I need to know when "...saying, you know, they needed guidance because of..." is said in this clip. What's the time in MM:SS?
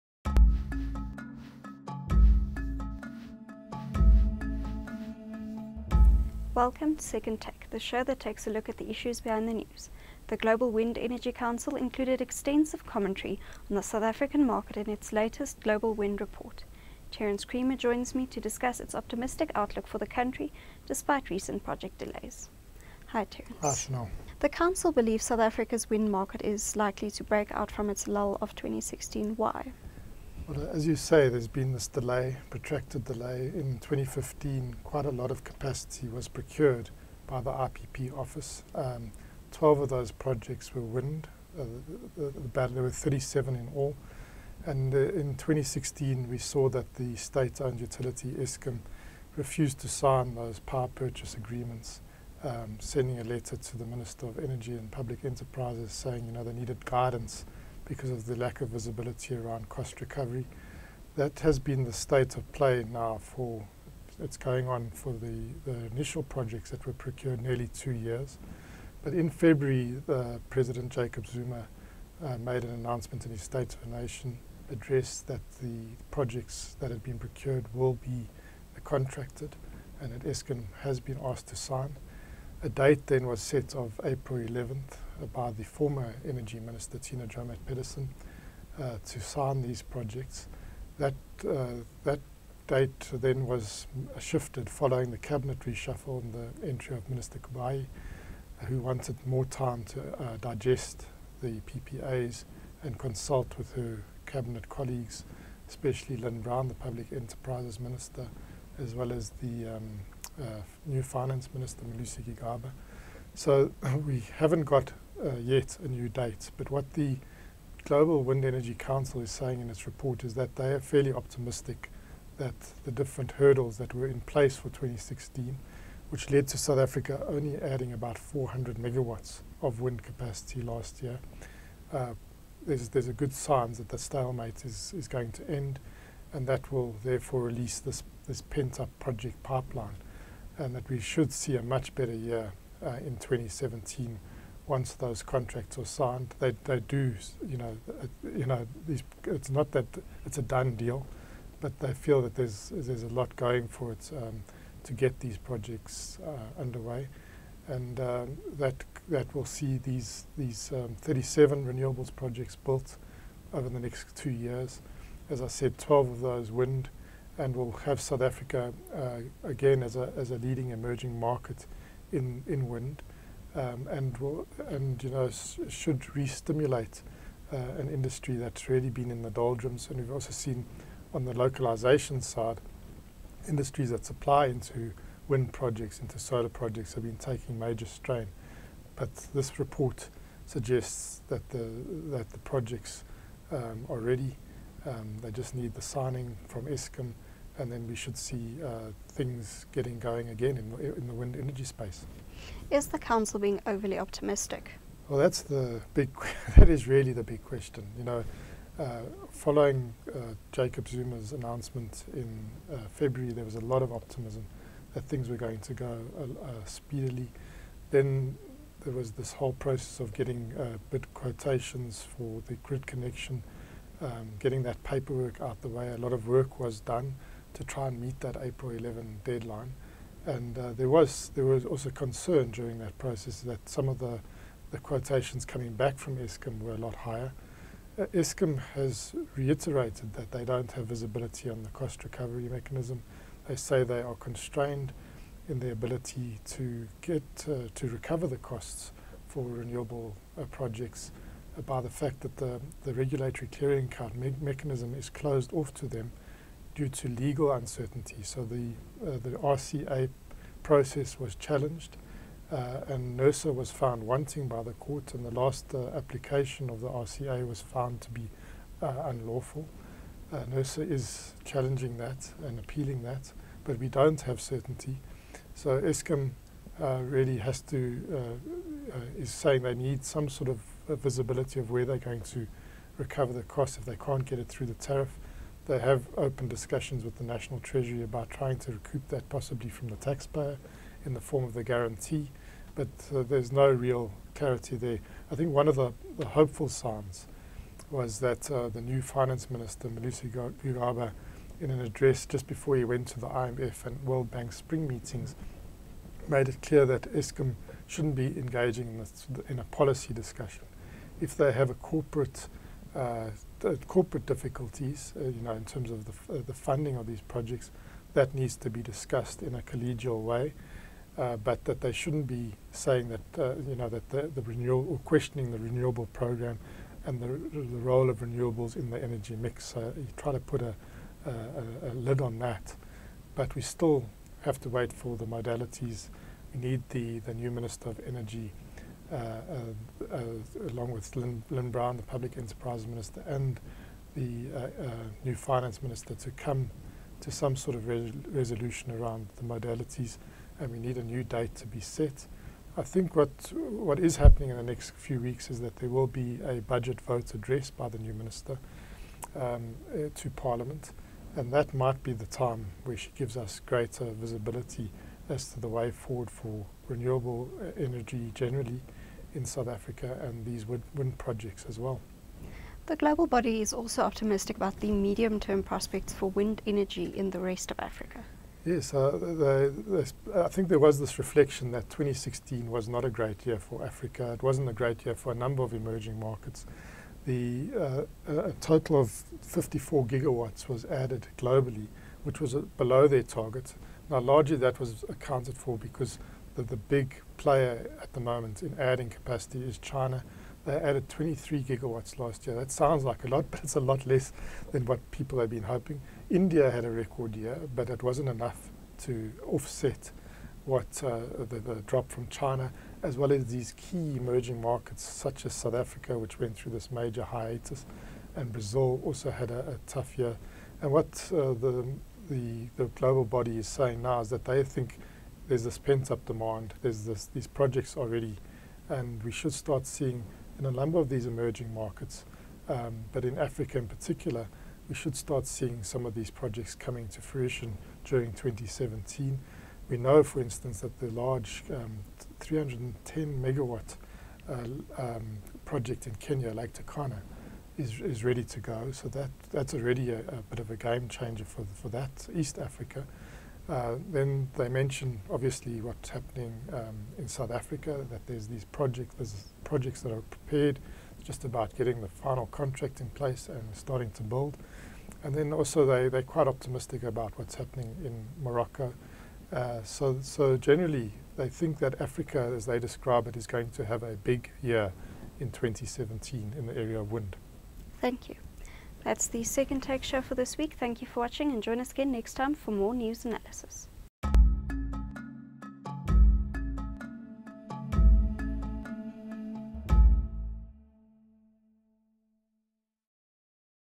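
00:55.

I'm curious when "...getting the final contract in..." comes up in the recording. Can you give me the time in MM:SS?
07:41.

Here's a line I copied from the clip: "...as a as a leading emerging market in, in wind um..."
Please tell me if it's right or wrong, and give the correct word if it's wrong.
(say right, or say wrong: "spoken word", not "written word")
right.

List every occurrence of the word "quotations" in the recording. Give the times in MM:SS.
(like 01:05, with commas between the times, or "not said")
03:41, 03:54.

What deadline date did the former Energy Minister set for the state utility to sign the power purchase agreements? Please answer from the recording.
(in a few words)
April 11th.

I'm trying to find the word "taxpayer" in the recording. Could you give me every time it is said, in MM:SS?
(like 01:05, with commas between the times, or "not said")
04:49.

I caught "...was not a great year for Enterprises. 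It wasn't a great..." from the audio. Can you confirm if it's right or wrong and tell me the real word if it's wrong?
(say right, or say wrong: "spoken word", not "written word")
wrong: "Africa", not "Enterprises".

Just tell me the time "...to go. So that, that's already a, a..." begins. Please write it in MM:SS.
07:28.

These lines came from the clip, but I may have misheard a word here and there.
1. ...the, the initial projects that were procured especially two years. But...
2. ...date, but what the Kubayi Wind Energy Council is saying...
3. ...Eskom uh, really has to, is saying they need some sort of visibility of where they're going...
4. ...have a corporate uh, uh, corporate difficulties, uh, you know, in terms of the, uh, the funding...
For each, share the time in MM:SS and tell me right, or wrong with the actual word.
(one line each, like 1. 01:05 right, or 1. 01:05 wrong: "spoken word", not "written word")
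1. 01:05 wrong: "nearly", not "especially"
2. 01:56 wrong: "Global", not "Kubayi"
3. 04:35 right
4. 05:11 right.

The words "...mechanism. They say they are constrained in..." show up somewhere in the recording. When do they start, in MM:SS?
04:02.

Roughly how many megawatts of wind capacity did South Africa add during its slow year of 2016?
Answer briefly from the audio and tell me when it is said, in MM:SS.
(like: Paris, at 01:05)
400, at 02:08.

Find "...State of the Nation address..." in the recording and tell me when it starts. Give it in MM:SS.
01:13.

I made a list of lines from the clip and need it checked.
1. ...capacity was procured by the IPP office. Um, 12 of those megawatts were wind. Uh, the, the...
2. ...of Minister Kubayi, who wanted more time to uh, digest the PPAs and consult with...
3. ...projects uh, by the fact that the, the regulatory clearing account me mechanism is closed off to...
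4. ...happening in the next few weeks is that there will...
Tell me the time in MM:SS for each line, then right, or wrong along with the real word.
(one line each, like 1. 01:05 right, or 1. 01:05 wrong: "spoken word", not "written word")
1. 00:35 wrong: "projects", not "megawatts"
2. 01:36 right
3. 04:10 right
4. 05:54 right.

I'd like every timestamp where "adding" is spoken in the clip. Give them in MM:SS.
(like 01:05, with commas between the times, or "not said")
02:07, 06:38.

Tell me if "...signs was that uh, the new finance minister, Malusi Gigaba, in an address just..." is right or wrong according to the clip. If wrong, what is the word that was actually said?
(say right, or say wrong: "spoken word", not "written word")
right.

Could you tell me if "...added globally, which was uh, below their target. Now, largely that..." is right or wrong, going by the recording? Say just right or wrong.
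right.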